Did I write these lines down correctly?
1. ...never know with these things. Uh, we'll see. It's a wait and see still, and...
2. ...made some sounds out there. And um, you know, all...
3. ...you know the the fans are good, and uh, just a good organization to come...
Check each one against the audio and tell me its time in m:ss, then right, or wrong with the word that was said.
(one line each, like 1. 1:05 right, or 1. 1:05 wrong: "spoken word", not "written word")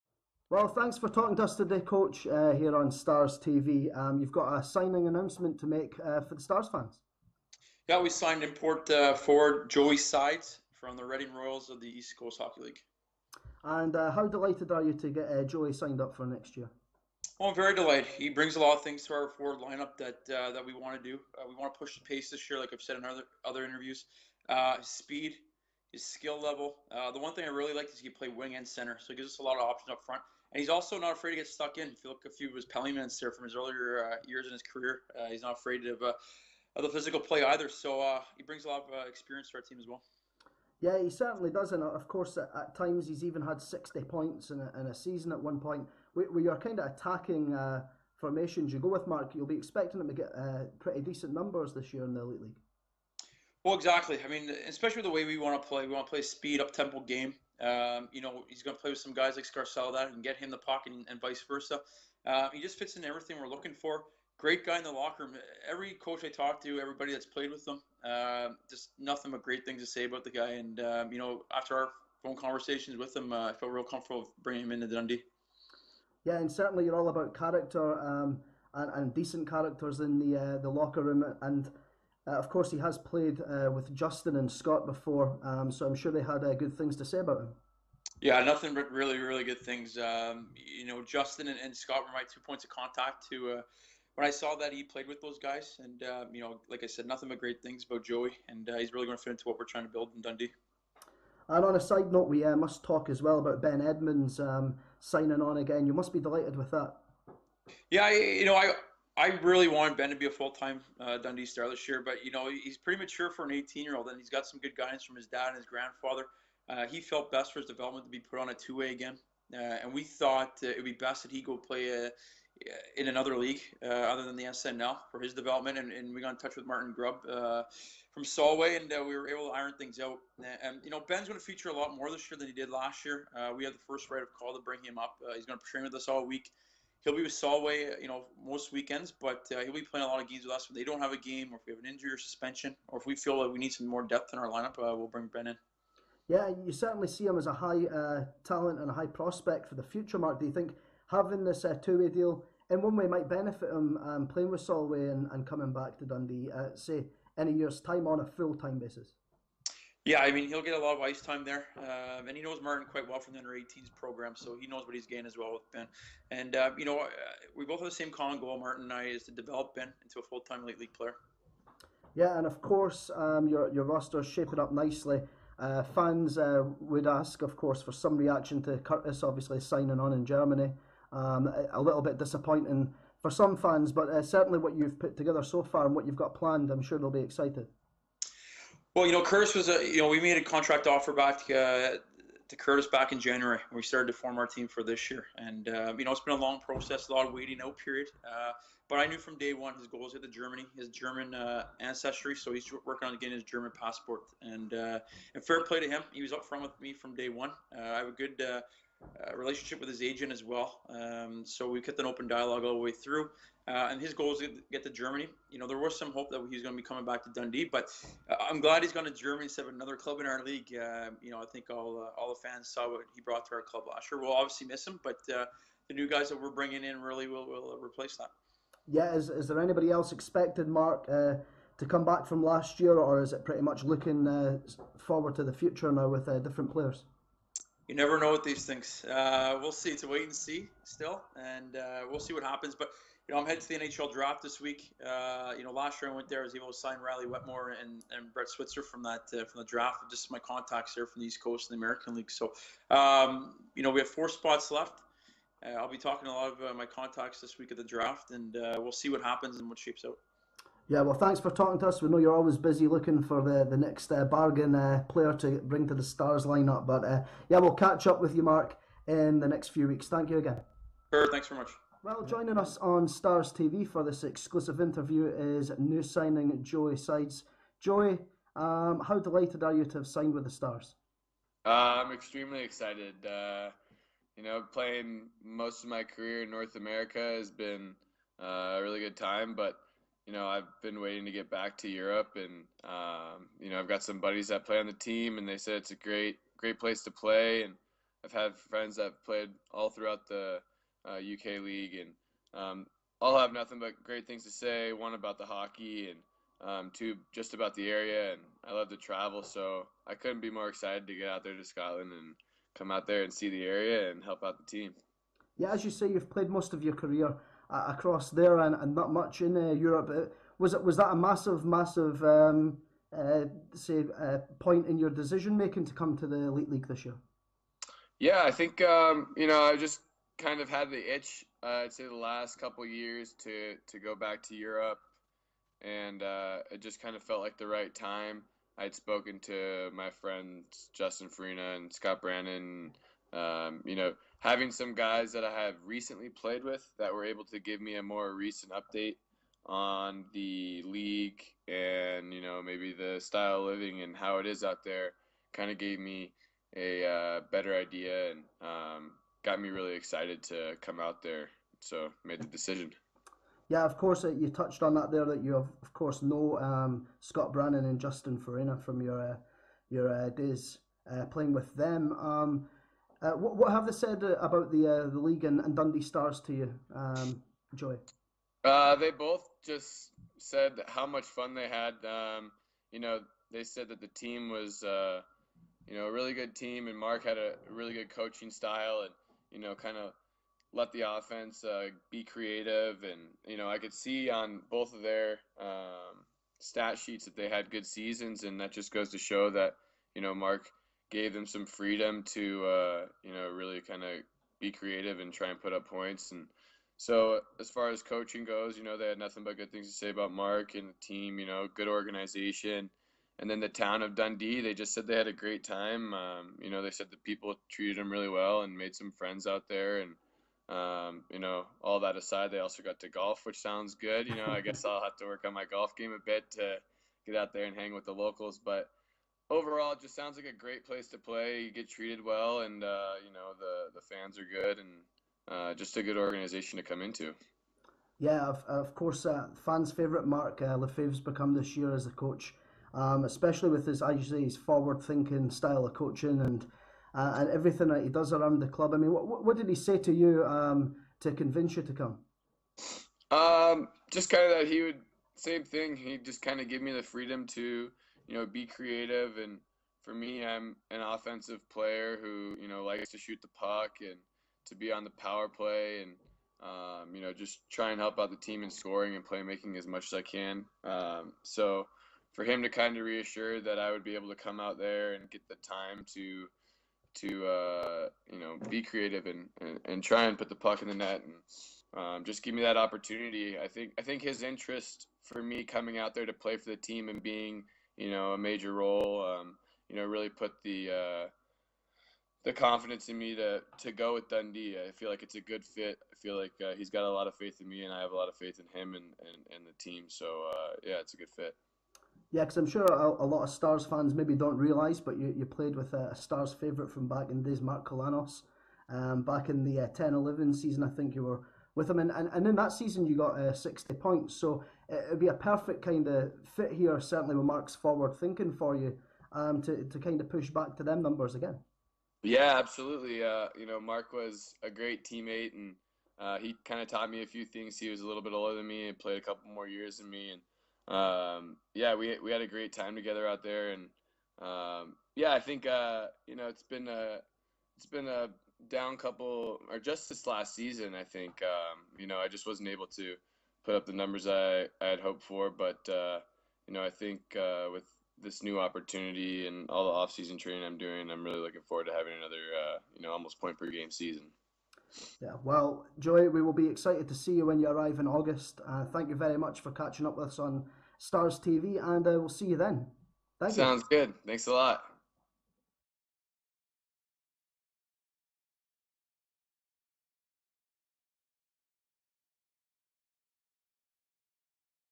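1. 3:57 right
2. 6:58 wrong: "friends", not "sounds"
3. 7:13 right.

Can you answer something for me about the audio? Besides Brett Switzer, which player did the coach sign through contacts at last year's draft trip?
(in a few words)
Riley Wetmore.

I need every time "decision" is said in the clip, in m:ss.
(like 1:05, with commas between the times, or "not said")
5:25, 6:02.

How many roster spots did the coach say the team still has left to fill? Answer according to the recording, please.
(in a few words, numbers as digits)
4.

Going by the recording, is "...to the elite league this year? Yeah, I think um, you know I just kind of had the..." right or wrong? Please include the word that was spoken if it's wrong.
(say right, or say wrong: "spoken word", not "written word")
right.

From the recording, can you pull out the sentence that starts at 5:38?
I'd spoken to my friends Justin Faryna and Scott Brannon.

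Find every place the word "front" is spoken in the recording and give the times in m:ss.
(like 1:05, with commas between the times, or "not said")
0:30, 3:26.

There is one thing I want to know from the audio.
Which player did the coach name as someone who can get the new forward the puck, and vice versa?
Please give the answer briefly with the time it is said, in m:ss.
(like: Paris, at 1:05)
Scarcella, at 0:59.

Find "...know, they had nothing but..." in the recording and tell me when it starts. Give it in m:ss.
6:48.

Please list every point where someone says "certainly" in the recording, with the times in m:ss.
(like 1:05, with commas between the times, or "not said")
0:41, 1:16, 2:26, 3:04, 8:36.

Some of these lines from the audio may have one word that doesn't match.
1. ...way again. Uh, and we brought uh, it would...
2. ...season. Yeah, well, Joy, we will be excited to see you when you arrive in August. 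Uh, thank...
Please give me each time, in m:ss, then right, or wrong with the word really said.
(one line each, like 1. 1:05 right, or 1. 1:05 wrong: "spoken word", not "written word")
1. 1:58 wrong: "thought", not "brought"
2. 9:13 right.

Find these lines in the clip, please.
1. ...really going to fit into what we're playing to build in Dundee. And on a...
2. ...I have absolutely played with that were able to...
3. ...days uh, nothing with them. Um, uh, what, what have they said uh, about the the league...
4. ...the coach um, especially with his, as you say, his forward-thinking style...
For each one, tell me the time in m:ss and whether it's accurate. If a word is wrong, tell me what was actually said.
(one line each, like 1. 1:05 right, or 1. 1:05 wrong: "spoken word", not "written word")
1. 1:38 wrong: "trying", not "playing"
2. 5:45 wrong: "recently", not "absolutely"
3. 6:10 wrong: "playing", not "nothing"
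4. 7:22 right.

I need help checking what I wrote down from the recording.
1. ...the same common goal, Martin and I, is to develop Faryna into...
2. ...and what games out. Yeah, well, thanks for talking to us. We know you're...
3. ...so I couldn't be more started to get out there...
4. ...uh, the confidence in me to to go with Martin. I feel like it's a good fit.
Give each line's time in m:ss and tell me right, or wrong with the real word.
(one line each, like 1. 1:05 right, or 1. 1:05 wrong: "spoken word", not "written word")
1. 2:47 wrong: "Ben", not "Faryna"
2. 4:19 wrong: "shapes", not "games"
3. 5:09 wrong: "excited", not "started"
4. 8:10 wrong: "Dundee", not "Martin".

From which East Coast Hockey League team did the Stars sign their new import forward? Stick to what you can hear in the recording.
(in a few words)
Reading Royals.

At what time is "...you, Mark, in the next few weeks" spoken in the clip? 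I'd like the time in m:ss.
4:28.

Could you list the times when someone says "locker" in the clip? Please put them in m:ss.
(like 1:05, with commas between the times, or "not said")
1:04, 1:20.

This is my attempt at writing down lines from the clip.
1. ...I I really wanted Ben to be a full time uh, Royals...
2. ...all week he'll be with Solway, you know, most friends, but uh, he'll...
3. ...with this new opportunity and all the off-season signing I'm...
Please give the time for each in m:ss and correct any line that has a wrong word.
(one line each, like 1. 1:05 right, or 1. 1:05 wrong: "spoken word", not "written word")
1. 1:48 wrong: "Dundee", not "Royals"
2. 2:16 wrong: "weekends", not "friends"
3. 9:07 wrong: "training", not "signing".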